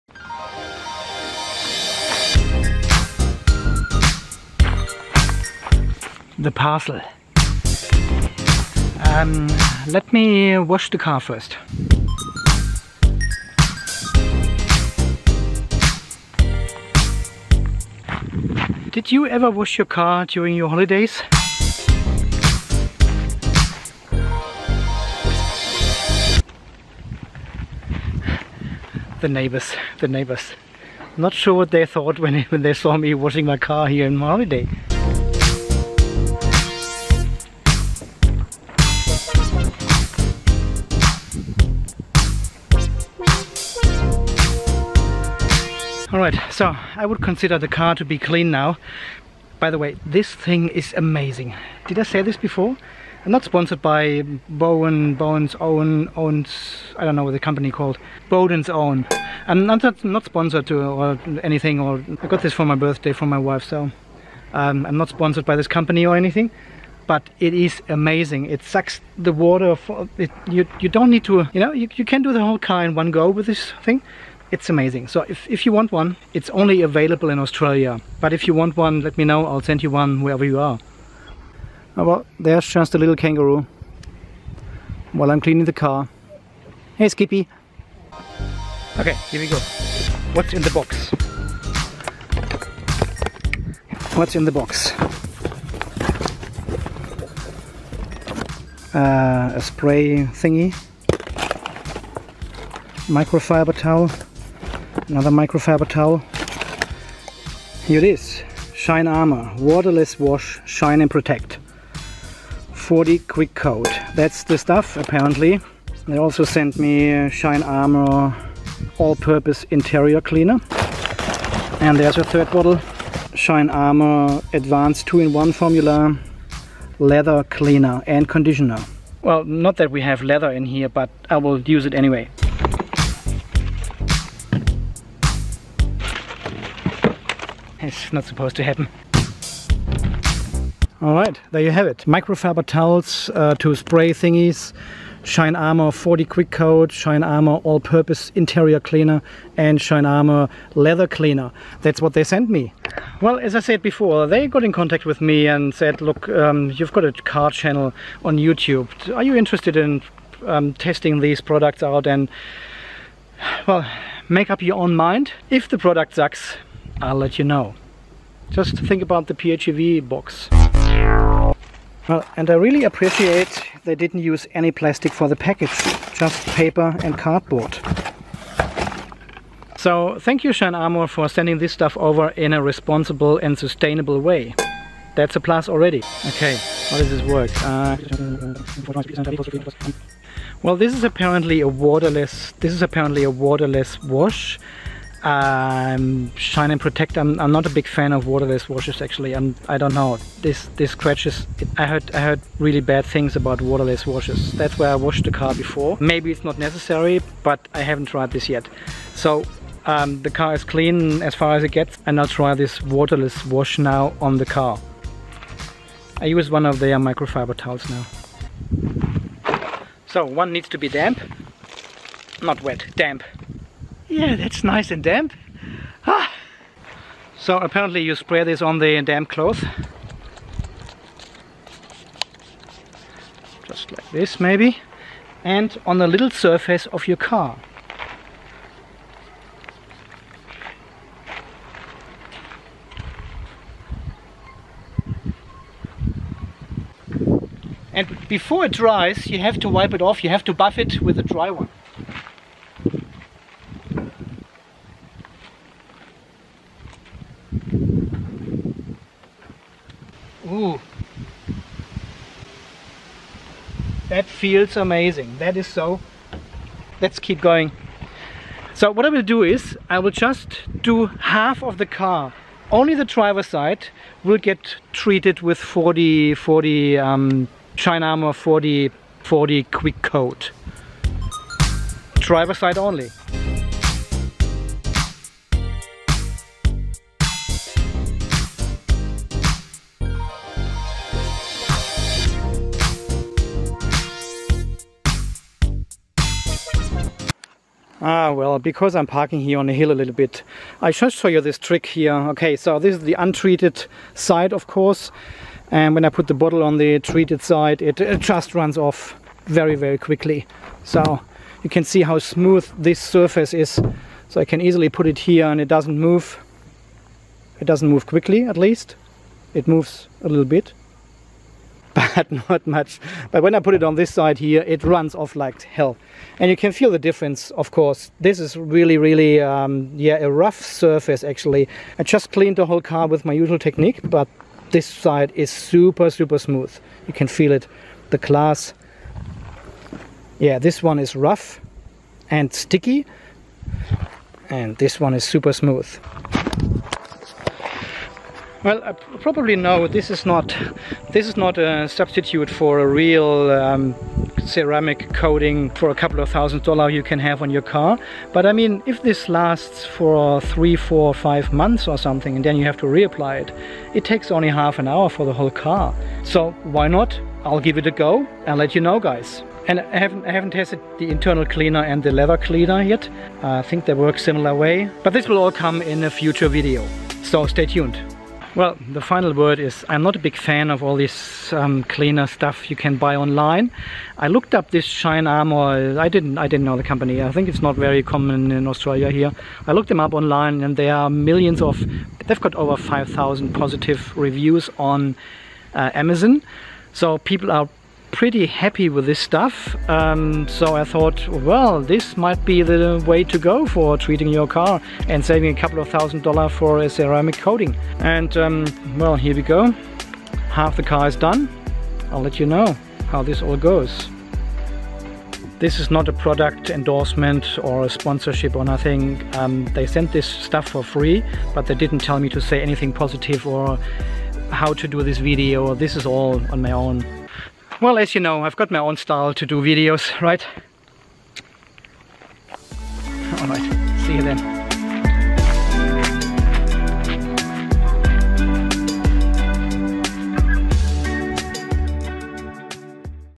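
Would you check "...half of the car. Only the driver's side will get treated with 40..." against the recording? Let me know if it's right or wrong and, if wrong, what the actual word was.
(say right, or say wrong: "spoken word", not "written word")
right.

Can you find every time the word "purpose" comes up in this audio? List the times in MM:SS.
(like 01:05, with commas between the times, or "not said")
01:58, 02:27.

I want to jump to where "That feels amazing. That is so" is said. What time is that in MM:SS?
04:24.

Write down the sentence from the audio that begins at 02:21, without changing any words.
All right, there you have it.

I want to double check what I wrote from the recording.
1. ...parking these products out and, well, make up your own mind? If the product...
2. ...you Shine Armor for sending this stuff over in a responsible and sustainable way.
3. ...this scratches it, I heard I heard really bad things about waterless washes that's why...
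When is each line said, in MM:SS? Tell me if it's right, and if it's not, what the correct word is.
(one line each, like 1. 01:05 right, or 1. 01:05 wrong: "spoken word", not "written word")
1. 02:40 wrong: "testing", not "parking"
2. 03:00 right
3. 03:20 right.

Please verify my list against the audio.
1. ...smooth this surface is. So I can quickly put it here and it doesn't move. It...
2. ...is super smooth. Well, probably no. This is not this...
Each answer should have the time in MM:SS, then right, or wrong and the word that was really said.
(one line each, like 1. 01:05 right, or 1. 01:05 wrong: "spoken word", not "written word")
1. 05:12 wrong: "easily", not "quickly"
2. 05:45 right.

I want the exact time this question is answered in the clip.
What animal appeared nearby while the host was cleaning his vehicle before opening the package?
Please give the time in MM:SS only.
01:23.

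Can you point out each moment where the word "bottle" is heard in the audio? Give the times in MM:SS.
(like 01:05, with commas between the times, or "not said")
02:02, 05:06.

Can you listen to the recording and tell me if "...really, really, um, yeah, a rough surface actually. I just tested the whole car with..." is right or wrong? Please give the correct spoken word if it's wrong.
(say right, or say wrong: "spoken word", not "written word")
wrong: "cleaned", not "tested".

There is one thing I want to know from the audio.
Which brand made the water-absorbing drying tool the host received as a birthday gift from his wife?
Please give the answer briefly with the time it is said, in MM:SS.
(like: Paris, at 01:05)
Bowden's Own, at 00:58.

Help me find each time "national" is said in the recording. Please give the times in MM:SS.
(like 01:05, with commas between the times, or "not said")
not said.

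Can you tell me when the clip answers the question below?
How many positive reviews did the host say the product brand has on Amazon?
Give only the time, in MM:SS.
06:32.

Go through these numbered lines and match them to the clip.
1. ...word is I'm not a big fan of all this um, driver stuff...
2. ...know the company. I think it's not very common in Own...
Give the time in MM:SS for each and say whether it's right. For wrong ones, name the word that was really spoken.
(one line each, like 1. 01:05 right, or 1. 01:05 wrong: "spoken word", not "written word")
1. 06:19 wrong: "cleaner", not "driver"
2. 06:26 wrong: "Australia", not "Own".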